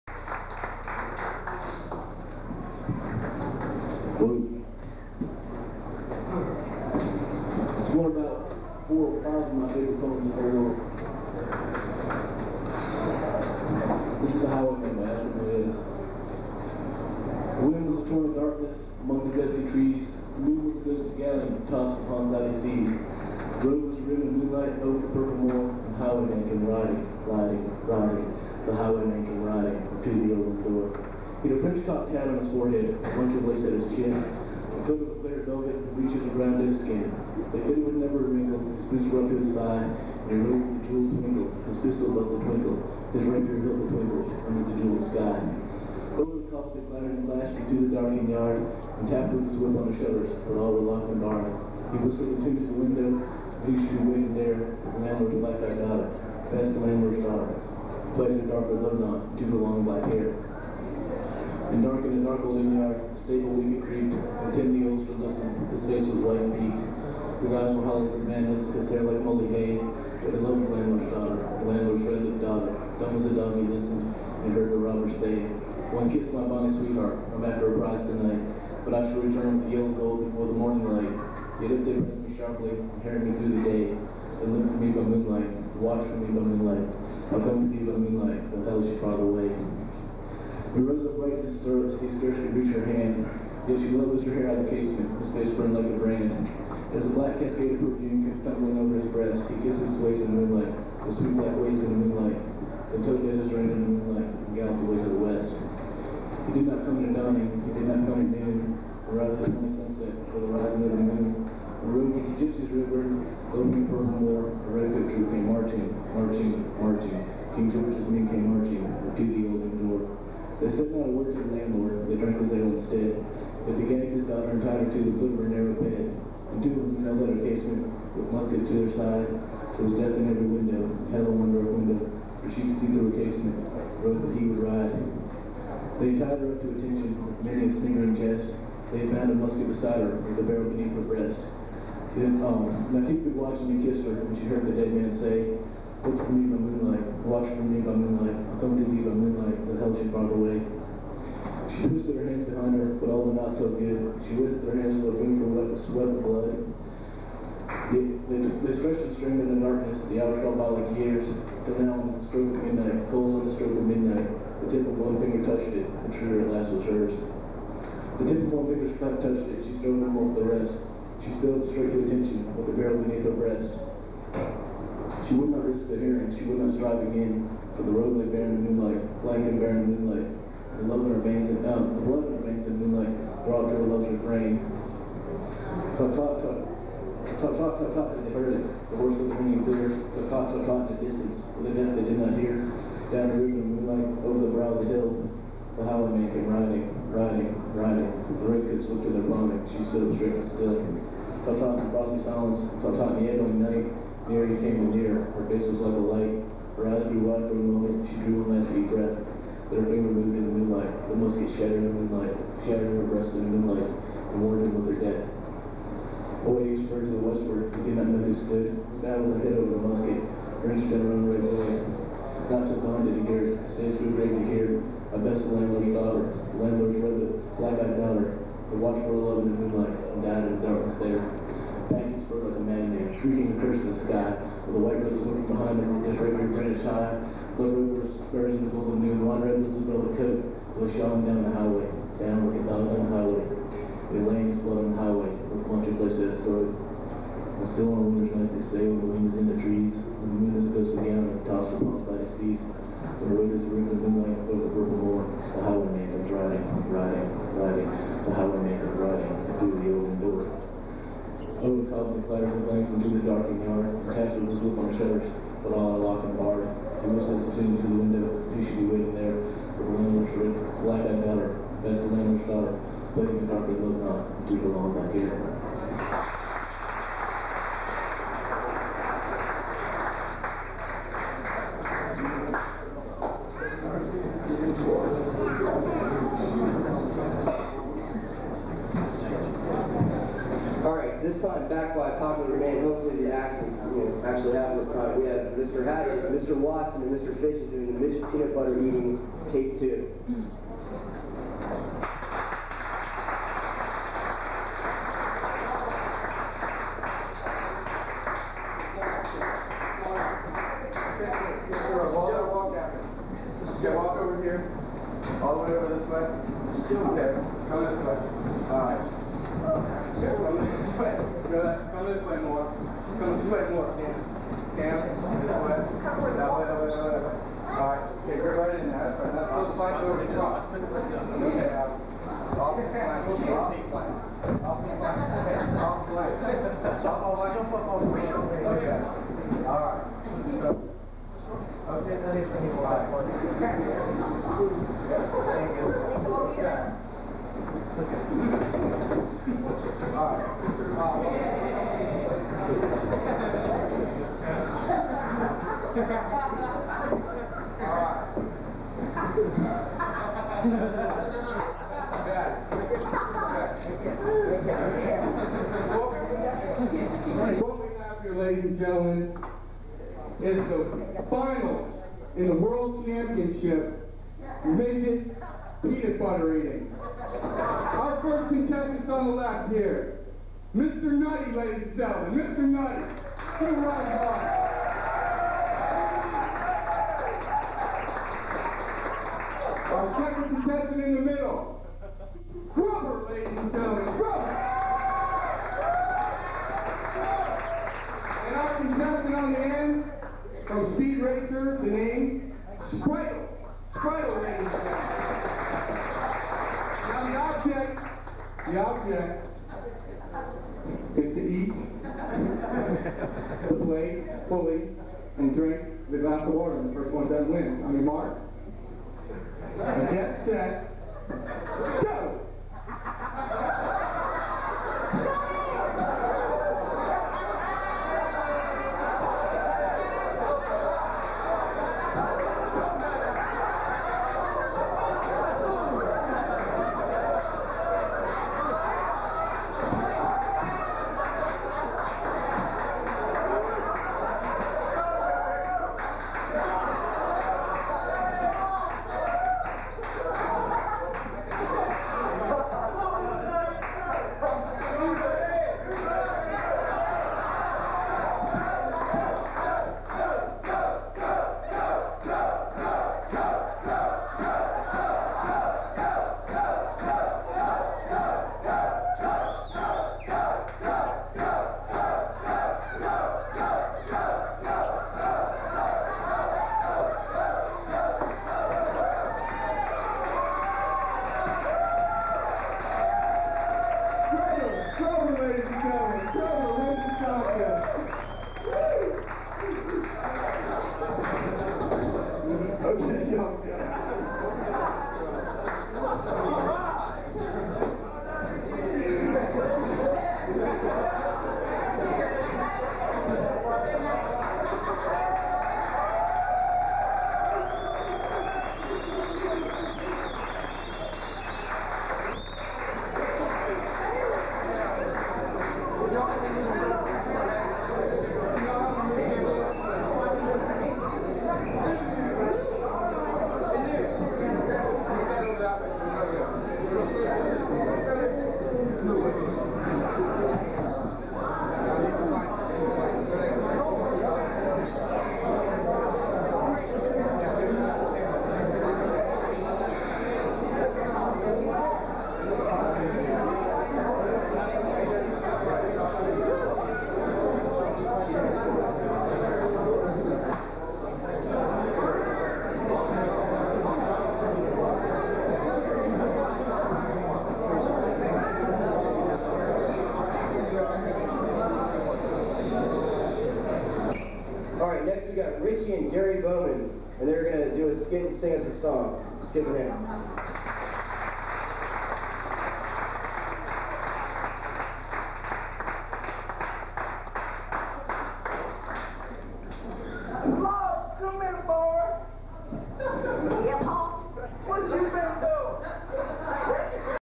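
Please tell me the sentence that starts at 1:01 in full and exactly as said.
And dark in the dark old yard, stable wicket creep.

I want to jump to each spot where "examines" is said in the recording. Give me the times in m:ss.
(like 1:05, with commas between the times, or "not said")
1:08.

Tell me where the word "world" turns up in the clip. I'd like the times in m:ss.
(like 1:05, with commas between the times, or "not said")
0:10, 6:12.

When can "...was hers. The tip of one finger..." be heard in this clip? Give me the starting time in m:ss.
2:46.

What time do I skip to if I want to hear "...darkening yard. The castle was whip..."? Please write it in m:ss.
4:23.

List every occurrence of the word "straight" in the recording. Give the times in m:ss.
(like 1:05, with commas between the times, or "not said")
2:51, 3:20.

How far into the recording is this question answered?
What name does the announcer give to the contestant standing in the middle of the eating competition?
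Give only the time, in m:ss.
6:32.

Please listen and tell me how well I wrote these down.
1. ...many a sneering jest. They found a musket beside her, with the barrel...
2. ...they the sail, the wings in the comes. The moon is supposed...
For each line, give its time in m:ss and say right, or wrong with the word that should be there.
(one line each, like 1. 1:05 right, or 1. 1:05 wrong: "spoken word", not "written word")
1. 2:17 right
2. 4:08 wrong: "trees", not "comes".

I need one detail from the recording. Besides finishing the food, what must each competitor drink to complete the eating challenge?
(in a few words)
glass of water.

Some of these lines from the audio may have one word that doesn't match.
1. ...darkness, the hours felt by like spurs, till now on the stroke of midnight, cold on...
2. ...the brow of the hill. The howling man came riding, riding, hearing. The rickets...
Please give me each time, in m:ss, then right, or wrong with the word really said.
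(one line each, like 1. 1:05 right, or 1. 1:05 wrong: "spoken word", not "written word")
1. 2:39 wrong: "years", not "spurs"
2. 3:14 wrong: "riding", not "hearing".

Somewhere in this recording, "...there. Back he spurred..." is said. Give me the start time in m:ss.
3:50.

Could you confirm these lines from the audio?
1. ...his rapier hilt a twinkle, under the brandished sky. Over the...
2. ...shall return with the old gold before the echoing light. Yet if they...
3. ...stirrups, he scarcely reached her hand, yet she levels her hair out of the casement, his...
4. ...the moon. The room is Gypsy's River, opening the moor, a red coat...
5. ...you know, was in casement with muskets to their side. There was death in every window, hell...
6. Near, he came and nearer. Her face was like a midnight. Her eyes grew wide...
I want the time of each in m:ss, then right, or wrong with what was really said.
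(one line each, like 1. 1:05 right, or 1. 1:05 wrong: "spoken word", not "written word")
1. 0:43 wrong: "jeweled", not "brandished"
2. 1:19 wrong: "morning", not "echoing"
3. 1:31 right
4. 1:50 right
5. 2:06 right
6. 3:24 wrong: "light", not "midnight".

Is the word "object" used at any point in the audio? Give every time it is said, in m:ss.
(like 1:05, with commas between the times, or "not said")
6:48.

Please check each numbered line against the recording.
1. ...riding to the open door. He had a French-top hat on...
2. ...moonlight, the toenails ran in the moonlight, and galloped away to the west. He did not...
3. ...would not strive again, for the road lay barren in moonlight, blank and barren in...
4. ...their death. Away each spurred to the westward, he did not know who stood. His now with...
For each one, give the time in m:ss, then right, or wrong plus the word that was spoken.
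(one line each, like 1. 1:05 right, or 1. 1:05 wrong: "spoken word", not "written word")
1. 0:29 right
2. 1:42 right
3. 2:56 right
4. 3:34 right.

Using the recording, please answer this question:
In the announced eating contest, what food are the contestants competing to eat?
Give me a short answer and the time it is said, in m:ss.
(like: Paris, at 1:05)
peanut butter, at 6:15.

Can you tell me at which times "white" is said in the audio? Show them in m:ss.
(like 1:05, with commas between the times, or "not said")
1:06, 3:54.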